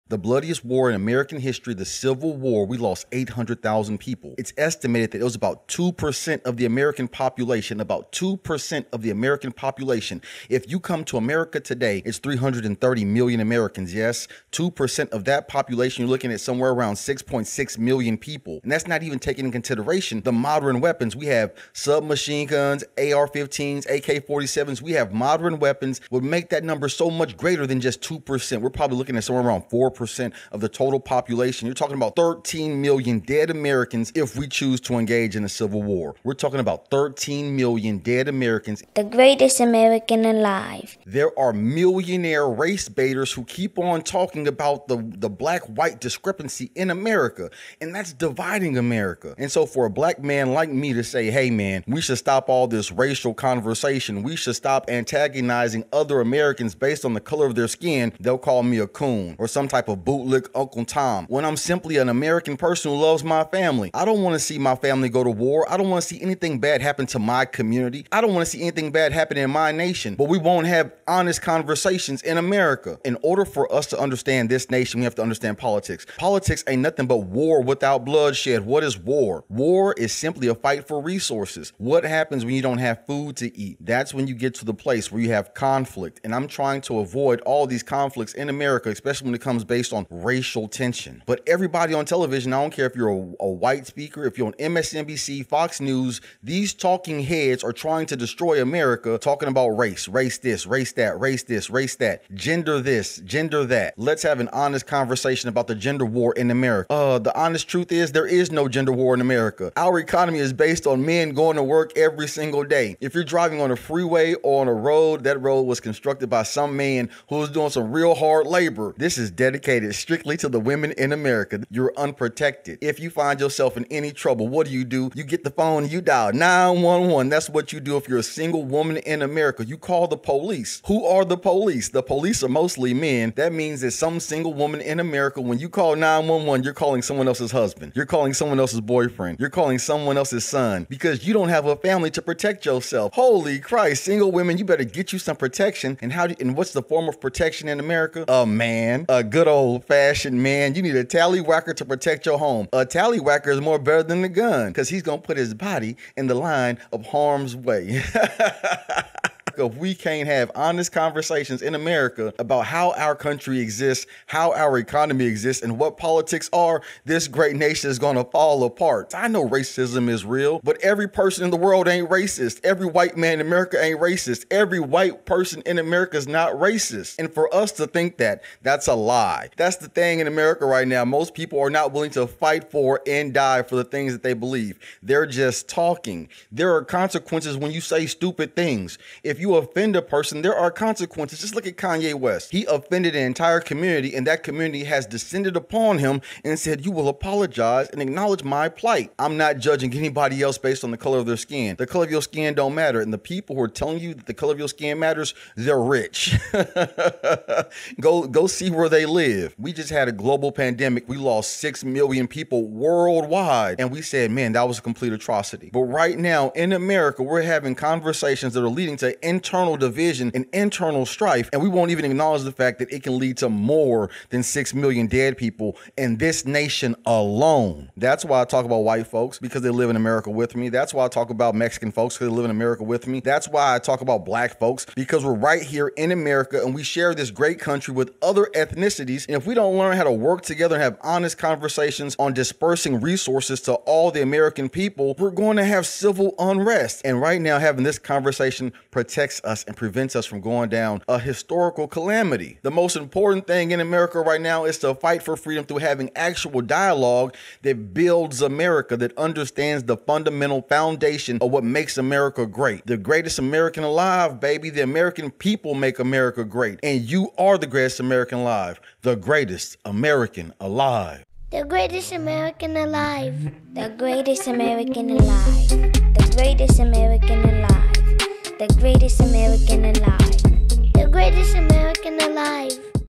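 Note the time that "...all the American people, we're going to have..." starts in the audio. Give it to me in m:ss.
4:03.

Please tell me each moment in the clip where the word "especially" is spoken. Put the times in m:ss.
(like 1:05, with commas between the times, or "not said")
1:28.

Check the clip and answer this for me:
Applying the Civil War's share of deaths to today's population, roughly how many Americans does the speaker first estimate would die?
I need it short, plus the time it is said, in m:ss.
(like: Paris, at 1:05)
6.6 million, at 0:16.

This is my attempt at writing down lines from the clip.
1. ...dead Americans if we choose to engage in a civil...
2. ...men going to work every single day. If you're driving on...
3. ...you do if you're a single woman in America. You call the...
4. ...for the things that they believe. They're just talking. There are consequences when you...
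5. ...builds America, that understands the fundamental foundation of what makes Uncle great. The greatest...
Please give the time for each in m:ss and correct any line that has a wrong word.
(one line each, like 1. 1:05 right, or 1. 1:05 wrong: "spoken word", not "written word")
1. 0:33 right
2. 1:51 right
3. 2:07 right
4. 3:03 right
5. 4:17 wrong: "America", not "Uncle".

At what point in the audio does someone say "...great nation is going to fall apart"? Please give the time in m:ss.
2:47.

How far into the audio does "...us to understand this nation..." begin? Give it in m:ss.
1:13.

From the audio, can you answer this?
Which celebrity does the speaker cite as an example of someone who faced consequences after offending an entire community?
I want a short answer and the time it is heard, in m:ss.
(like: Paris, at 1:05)
Kanye West, at 3:11.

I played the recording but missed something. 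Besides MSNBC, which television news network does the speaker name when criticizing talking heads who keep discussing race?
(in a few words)
Fox News.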